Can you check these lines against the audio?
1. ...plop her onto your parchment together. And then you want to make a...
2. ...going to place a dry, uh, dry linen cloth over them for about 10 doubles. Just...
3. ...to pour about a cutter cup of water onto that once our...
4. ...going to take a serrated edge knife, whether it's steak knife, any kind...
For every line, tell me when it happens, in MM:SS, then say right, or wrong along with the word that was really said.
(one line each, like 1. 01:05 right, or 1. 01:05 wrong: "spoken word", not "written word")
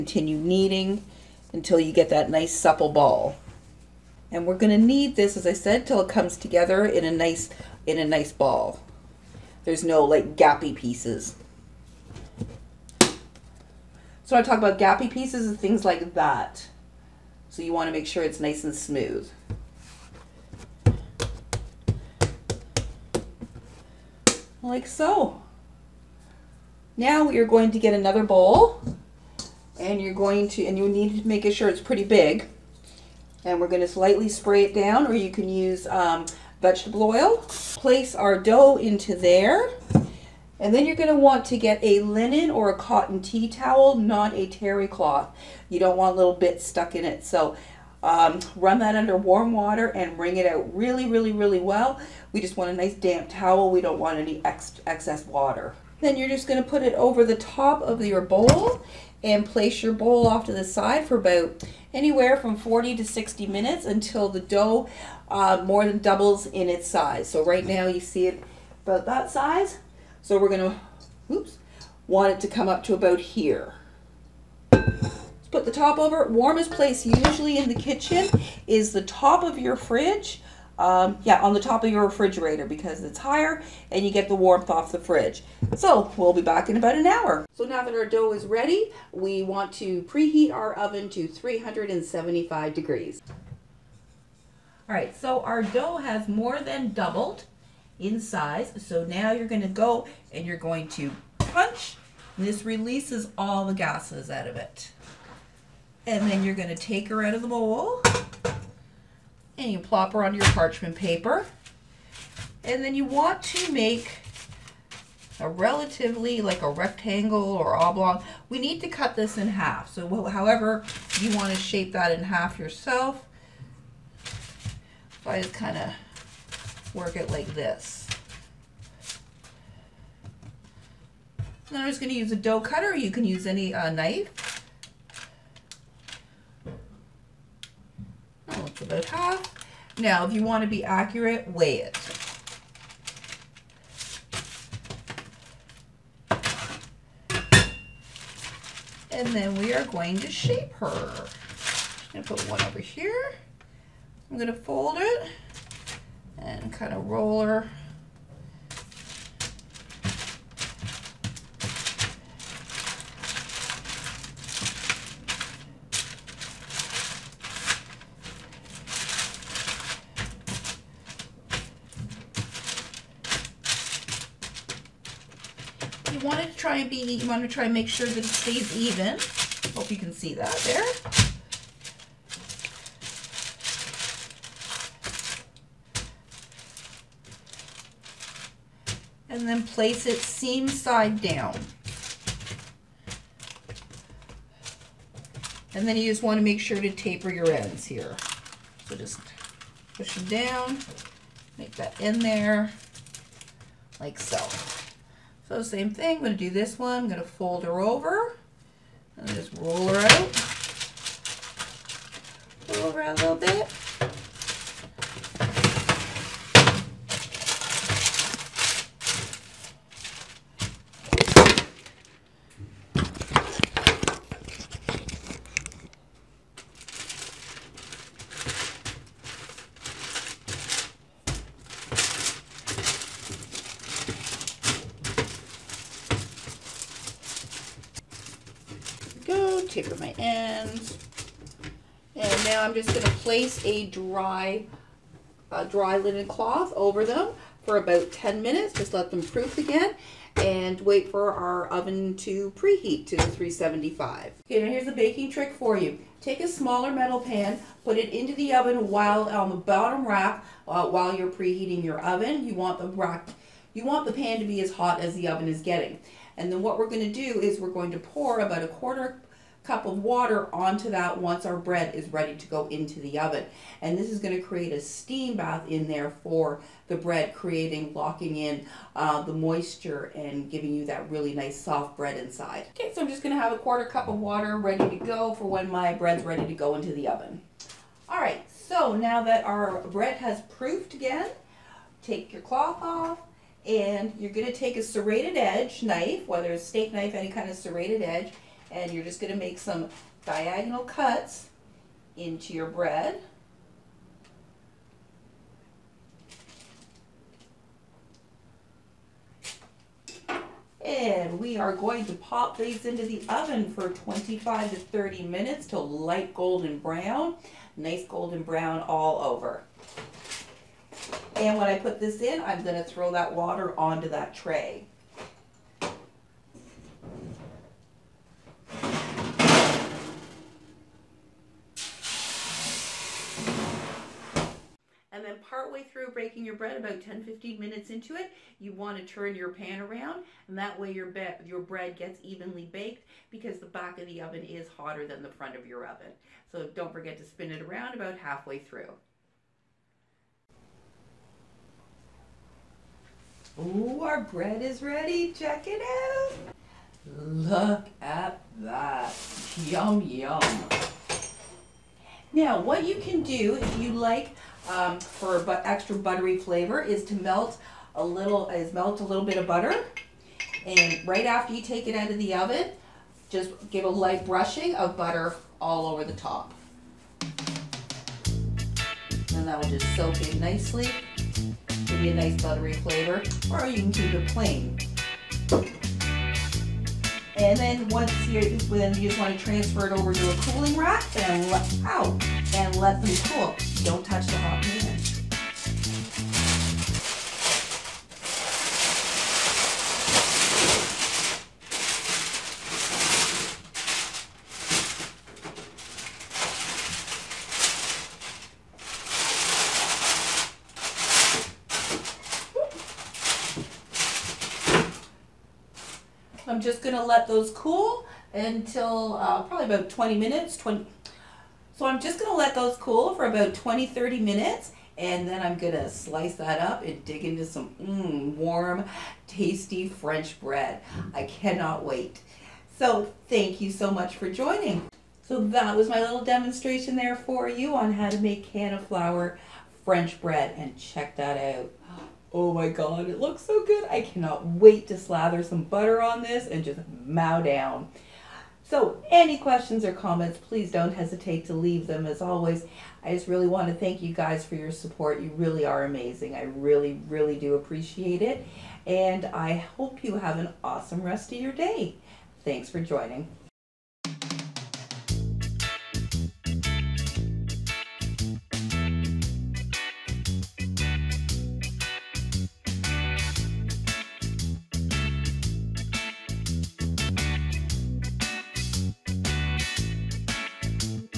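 1. 01:49 wrong: "paper", not "together"
2. 04:02 wrong: "minutes", not "doubles"
3. 04:27 wrong: "quarter", not "cutter"
4. 04:54 right.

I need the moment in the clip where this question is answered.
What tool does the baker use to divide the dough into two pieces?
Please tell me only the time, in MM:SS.
02:12.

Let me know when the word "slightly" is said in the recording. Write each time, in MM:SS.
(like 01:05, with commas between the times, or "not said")
00:33.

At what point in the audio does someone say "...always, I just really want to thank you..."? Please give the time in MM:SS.
07:32.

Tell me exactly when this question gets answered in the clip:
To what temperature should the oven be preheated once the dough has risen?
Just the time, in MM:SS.
01:31.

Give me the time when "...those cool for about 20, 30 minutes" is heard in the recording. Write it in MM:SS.
07:02.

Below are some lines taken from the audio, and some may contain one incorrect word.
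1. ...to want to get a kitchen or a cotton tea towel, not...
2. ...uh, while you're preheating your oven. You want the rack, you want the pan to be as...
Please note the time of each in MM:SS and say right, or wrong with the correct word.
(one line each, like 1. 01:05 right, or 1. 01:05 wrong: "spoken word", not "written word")
1. 00:41 wrong: "linen", not "kitchen"
2. 04:20 right.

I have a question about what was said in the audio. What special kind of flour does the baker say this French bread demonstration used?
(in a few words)
canna flour.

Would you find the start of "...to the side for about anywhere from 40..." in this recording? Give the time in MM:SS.
01:00.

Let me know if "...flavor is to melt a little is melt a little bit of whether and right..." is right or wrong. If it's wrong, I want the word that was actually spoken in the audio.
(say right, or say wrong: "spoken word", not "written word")
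wrong: "butter", not "whether".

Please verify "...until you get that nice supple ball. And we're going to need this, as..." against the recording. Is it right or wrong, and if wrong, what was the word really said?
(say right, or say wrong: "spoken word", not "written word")
right.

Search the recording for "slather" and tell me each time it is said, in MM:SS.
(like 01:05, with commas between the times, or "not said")
07:24.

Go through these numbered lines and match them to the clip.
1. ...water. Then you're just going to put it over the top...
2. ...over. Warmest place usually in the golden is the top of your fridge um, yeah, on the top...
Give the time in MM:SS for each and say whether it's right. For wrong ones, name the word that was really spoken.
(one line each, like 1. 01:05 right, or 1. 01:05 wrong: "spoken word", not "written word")
1. 00:55 right
2. 01:15 wrong: "kitchen", not "golden".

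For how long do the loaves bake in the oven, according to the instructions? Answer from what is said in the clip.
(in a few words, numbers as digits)
25 to 30 minutes.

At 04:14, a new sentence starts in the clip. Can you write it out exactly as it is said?
Okay, now here's a baking trick for you.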